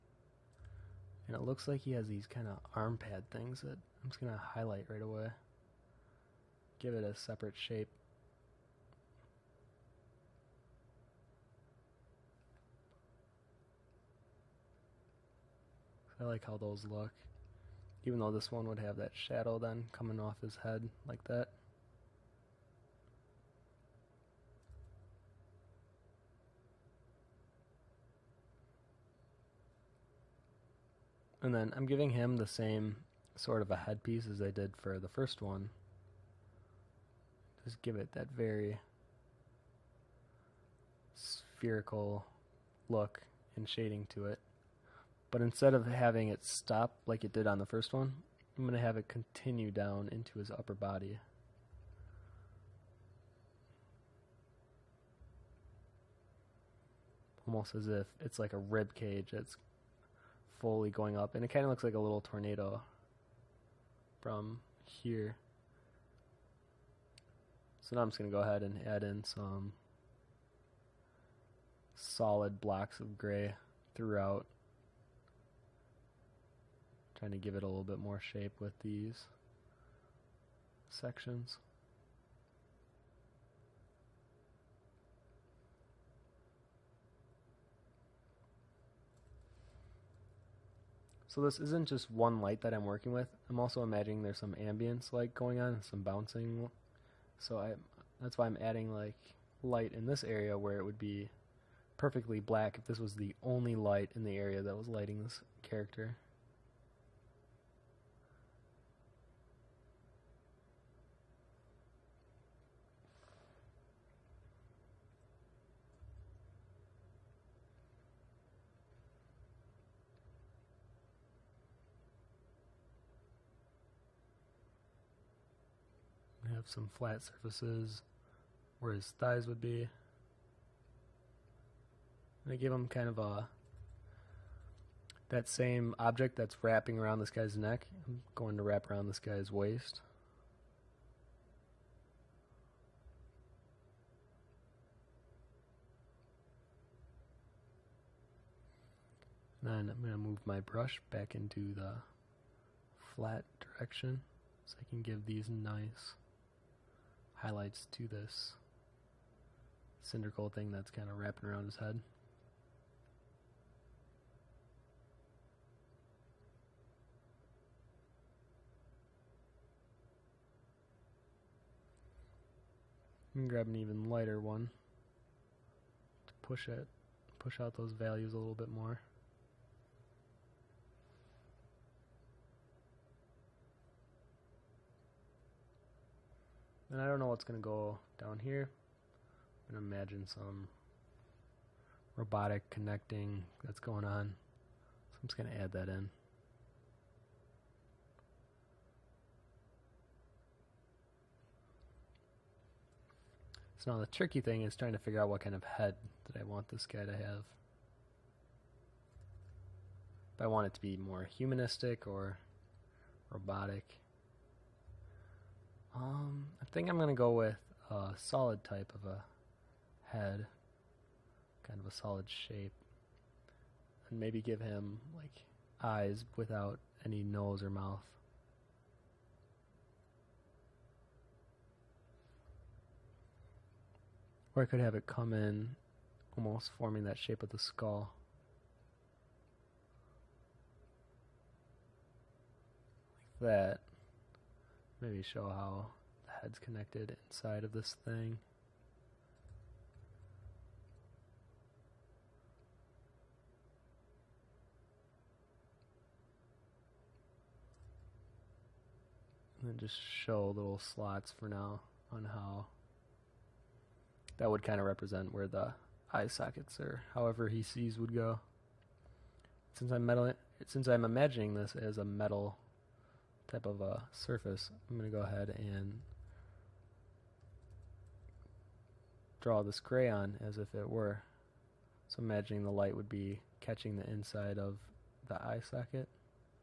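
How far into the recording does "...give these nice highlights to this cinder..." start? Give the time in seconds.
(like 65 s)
155 s.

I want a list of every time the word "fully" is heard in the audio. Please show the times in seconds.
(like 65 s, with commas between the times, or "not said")
60 s.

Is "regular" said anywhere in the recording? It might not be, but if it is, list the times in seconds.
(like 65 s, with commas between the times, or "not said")
not said.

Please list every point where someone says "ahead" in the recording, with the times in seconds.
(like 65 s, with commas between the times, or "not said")
68 s, 275 s.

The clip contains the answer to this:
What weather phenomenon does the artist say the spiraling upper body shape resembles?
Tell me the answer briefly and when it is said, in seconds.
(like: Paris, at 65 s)
a little tornado, at 61 s.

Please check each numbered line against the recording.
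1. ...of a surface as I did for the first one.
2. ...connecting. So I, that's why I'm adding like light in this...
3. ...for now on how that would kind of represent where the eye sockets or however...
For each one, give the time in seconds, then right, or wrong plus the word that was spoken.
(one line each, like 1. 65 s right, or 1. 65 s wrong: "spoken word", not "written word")
1. 33 s wrong: "headpiece", not "surface"
2. 96 s wrong: "bouncing", not "connecting"
3. 261 s right.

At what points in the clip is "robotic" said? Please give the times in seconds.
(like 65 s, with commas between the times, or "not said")
192 s, 213 s.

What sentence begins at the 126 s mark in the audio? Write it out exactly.
some flat surfaces where his thighs would be.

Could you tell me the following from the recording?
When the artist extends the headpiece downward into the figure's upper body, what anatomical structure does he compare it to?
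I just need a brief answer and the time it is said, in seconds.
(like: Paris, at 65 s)
rib cage, at 58 s.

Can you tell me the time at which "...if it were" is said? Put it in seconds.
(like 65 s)
280 s.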